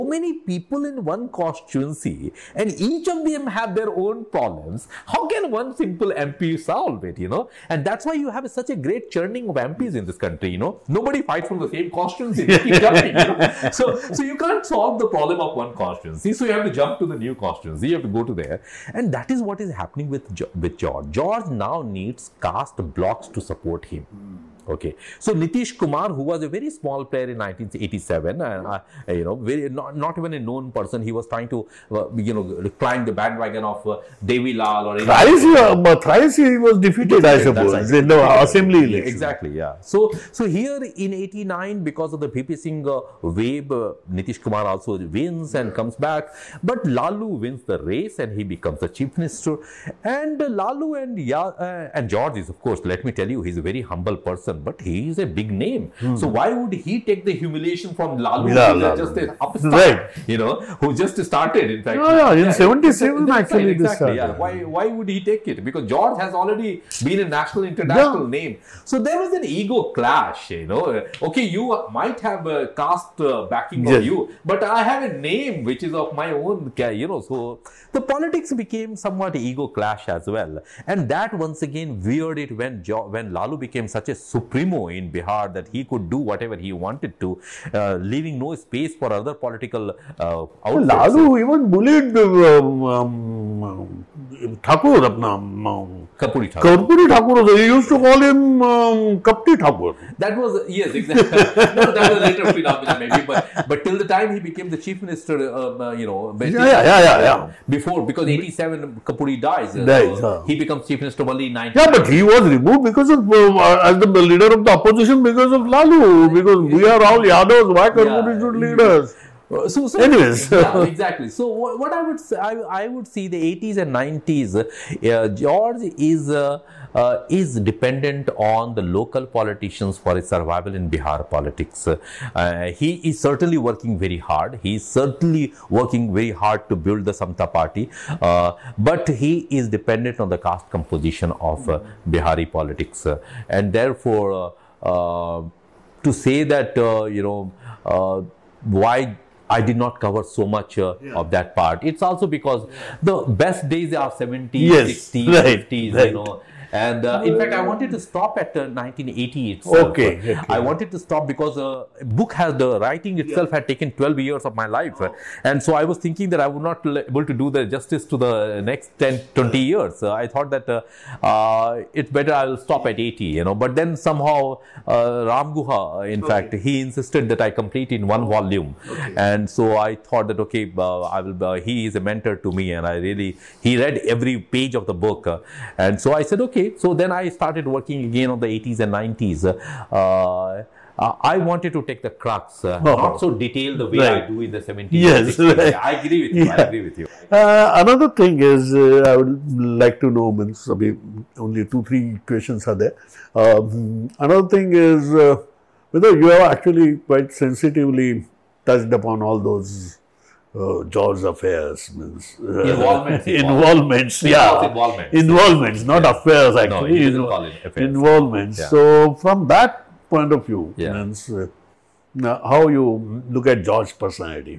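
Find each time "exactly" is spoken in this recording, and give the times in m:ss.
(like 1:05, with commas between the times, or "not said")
0:39, 1:03, 1:40, 2:00.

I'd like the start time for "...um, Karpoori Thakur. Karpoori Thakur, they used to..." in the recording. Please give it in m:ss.
1:35.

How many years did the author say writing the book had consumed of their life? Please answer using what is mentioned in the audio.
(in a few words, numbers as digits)
12.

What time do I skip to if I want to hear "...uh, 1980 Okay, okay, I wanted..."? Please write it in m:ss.
2:38.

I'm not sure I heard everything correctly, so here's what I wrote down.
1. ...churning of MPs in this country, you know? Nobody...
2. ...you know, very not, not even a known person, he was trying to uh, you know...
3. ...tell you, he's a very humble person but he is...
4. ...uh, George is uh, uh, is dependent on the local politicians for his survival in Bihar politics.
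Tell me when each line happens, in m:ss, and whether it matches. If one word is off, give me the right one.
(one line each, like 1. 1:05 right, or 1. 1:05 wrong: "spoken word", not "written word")
1. 0:09 right
2. 0:29 right
3. 0:53 right
4. 2:04 right.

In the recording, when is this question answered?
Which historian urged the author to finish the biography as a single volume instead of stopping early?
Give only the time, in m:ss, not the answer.
2:55.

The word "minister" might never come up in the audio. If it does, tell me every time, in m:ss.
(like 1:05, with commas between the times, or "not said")
0:49, 1:45, 1:50.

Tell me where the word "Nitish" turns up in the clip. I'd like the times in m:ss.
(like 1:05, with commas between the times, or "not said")
0:25, 0:44.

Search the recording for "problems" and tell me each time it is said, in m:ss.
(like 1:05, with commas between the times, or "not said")
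0:04, 0:15.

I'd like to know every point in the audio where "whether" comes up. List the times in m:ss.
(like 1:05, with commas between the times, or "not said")
3:25.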